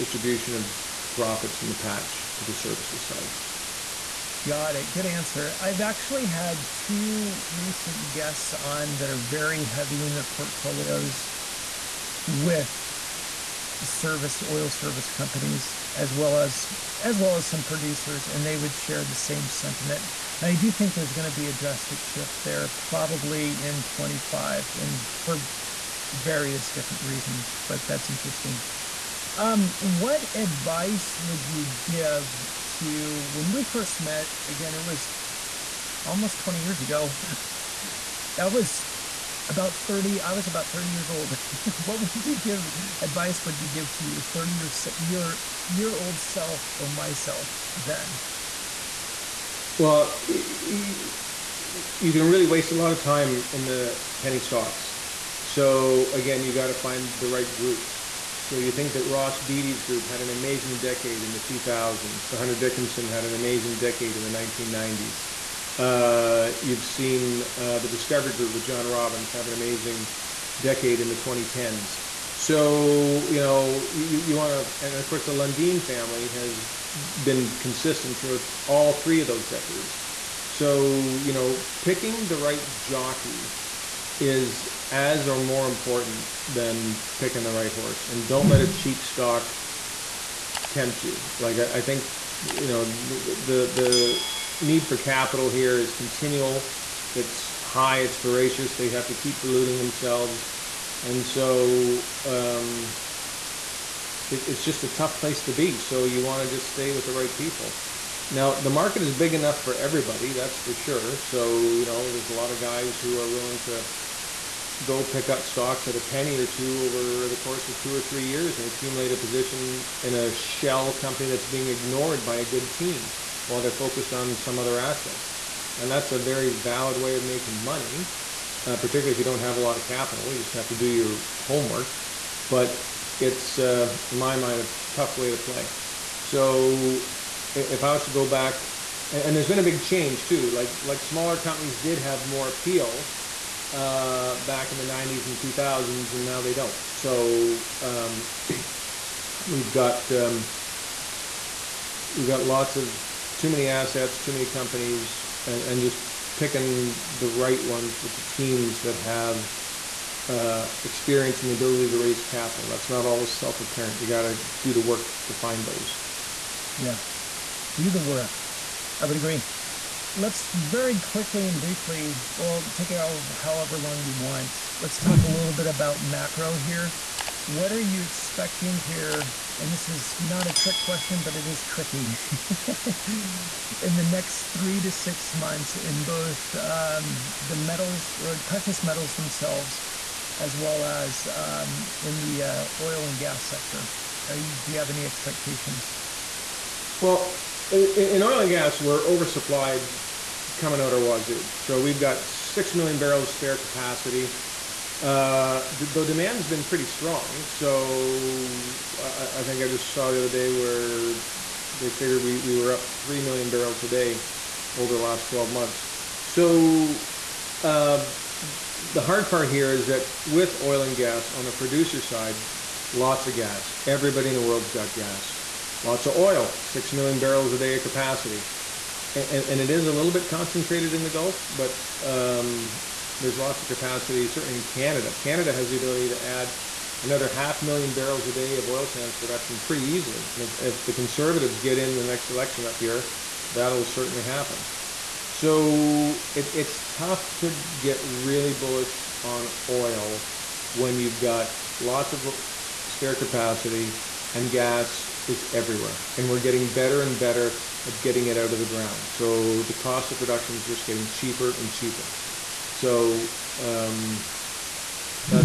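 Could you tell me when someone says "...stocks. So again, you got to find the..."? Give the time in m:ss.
0:54.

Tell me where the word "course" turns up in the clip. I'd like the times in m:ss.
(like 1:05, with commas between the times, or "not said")
1:15, 1:57.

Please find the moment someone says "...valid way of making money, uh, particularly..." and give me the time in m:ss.
2:06.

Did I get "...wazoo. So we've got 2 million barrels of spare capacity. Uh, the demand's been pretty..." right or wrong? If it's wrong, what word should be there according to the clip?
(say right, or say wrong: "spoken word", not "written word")
wrong: "6", not "2".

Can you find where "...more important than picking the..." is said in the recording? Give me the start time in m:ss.
1:25.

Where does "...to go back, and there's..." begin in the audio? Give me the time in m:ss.
2:18.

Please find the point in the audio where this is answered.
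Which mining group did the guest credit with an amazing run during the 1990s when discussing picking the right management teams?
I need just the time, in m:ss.
1:02.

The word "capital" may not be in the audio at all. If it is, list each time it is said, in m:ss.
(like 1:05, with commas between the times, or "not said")
1:34, 2:09, 2:42.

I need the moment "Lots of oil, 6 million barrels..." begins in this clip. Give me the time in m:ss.
3:45.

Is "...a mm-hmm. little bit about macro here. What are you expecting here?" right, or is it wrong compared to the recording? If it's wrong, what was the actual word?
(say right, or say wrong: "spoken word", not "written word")
right.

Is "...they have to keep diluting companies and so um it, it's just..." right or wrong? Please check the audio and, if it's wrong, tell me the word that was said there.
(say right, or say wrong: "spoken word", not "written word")
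wrong: "themselves", not "companies".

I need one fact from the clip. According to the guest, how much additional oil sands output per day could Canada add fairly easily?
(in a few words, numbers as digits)
half million barrels.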